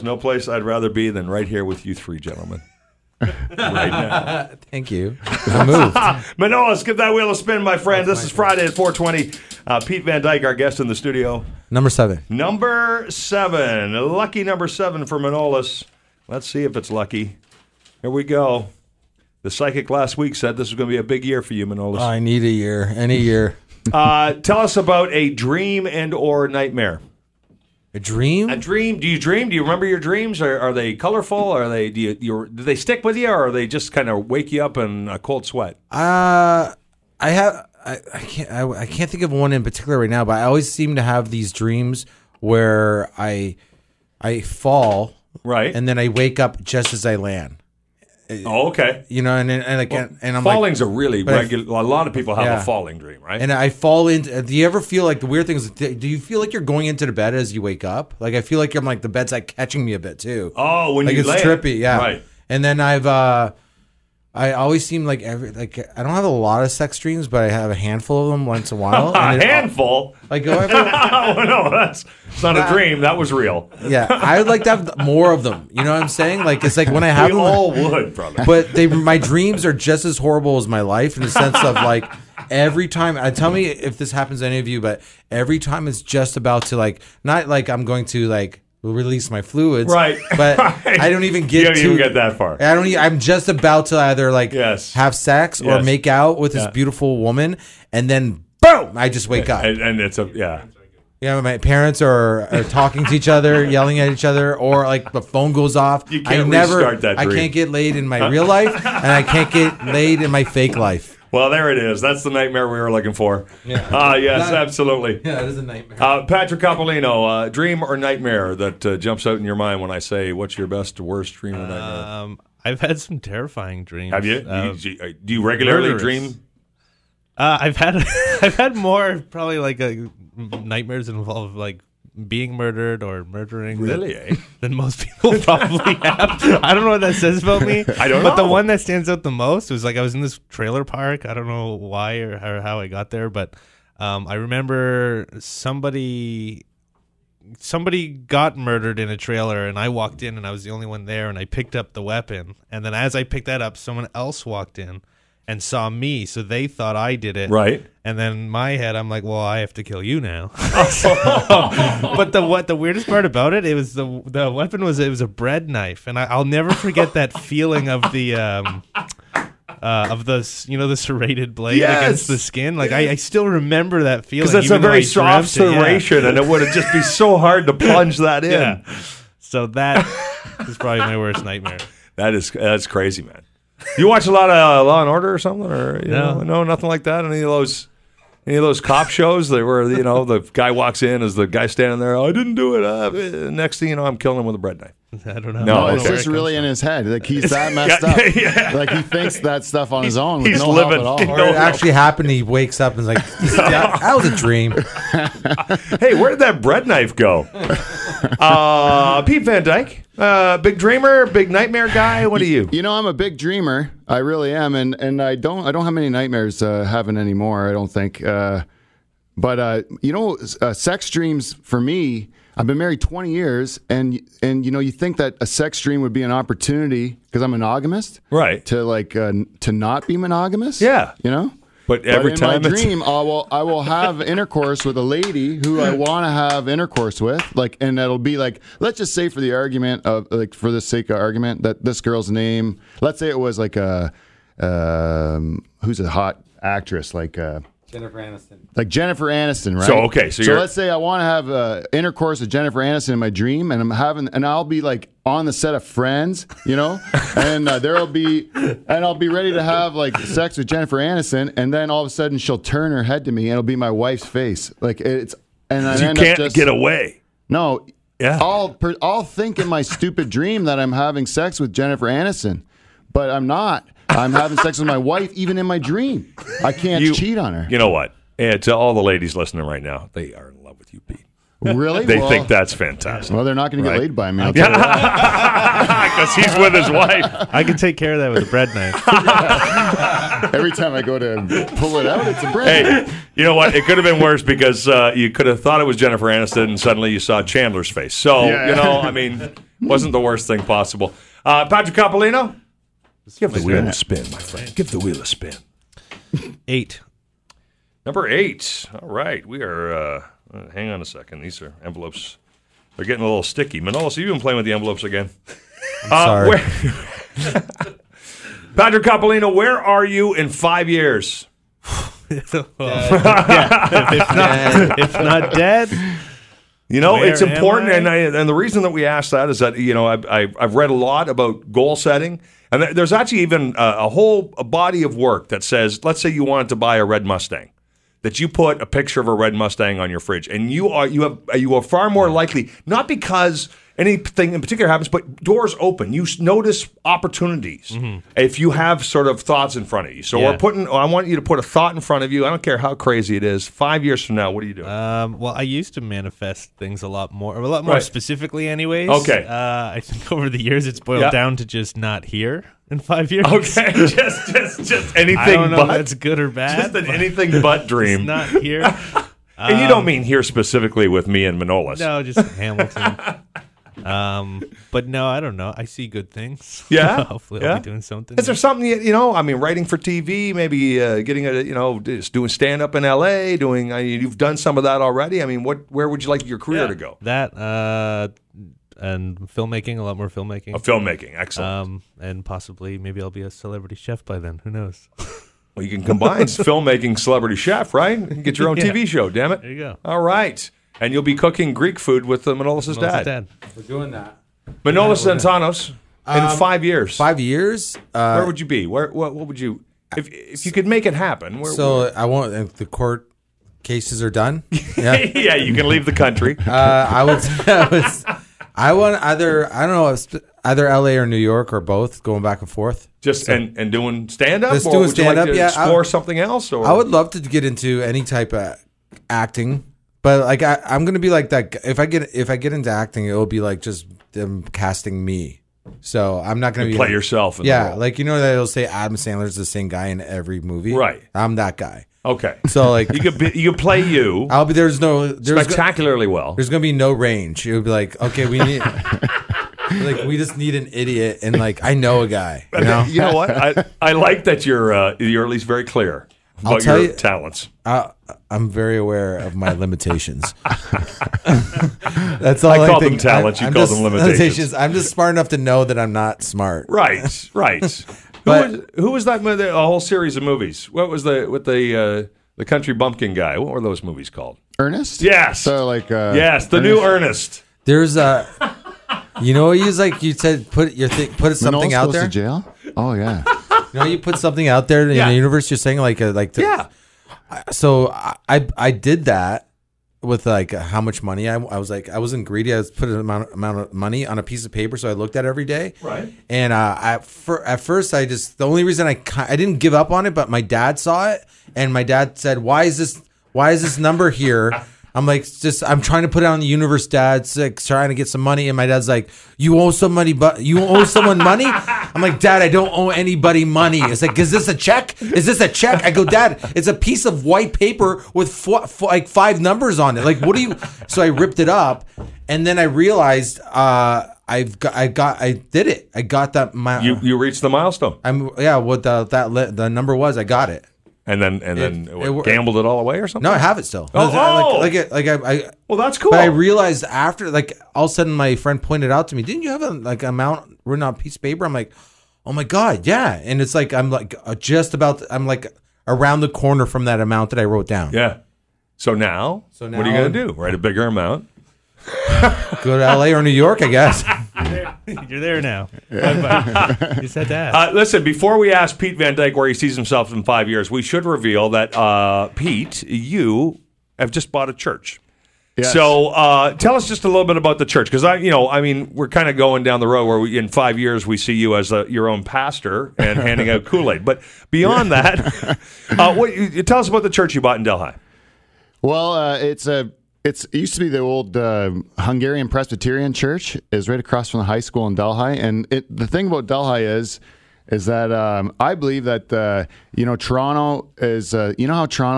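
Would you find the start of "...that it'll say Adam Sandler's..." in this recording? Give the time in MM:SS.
07:18.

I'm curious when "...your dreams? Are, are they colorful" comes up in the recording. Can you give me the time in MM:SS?
00:29.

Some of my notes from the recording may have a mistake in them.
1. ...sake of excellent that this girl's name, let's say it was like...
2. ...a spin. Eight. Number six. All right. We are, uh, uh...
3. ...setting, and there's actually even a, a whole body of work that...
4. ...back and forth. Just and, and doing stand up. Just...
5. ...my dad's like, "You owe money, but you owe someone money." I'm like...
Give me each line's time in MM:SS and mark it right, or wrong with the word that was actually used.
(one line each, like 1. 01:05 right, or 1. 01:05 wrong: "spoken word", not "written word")
1. 04:00 wrong: "argument", not "excellent"
2. 05:05 wrong: "eight", not "six"
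3. 05:31 right
4. 07:02 right
5. 08:28 right.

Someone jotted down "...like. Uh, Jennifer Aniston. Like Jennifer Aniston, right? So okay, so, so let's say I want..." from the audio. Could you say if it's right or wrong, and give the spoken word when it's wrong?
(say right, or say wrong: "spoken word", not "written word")
right.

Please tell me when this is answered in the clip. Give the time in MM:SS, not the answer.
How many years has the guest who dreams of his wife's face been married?
03:42.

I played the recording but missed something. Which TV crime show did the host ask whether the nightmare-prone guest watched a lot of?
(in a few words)
Law and Order.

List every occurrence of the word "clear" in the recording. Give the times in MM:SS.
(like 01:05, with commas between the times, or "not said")
07:35.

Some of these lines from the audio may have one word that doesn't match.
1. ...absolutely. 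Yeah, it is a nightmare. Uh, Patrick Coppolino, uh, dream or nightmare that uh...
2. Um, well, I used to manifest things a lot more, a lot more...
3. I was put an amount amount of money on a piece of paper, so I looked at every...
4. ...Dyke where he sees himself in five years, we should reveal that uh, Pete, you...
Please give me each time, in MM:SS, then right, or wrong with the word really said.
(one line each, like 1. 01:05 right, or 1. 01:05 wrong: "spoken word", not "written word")
1. 01:54 right
2. 05:54 right
3. 08:12 right
4. 09:19 right.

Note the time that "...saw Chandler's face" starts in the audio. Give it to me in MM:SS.
04:57.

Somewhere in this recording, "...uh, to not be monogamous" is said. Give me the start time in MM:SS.
03:49.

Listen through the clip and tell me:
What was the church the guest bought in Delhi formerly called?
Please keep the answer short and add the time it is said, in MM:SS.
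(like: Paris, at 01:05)
Hungarian Presbyterian Church, at 09:42.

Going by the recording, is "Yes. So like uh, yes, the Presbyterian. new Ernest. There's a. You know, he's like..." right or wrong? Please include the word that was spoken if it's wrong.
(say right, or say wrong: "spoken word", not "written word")
wrong: "Ernest", not "Presbyterian".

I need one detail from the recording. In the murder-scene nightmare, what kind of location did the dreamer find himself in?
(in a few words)
trailer park.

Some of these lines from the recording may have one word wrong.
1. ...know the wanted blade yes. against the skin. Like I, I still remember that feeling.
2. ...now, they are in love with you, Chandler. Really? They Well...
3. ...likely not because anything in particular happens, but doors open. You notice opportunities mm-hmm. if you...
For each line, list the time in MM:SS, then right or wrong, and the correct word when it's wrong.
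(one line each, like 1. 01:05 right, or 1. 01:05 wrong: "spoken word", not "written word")
1. 02:50 wrong: "serrated", not "wanted"
2. 04:39 wrong: "Pete", not "Chandler"
3. 05:42 right.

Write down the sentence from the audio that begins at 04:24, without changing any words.
Like it's, and I you can't just, get away.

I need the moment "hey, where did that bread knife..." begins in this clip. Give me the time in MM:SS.
03:25.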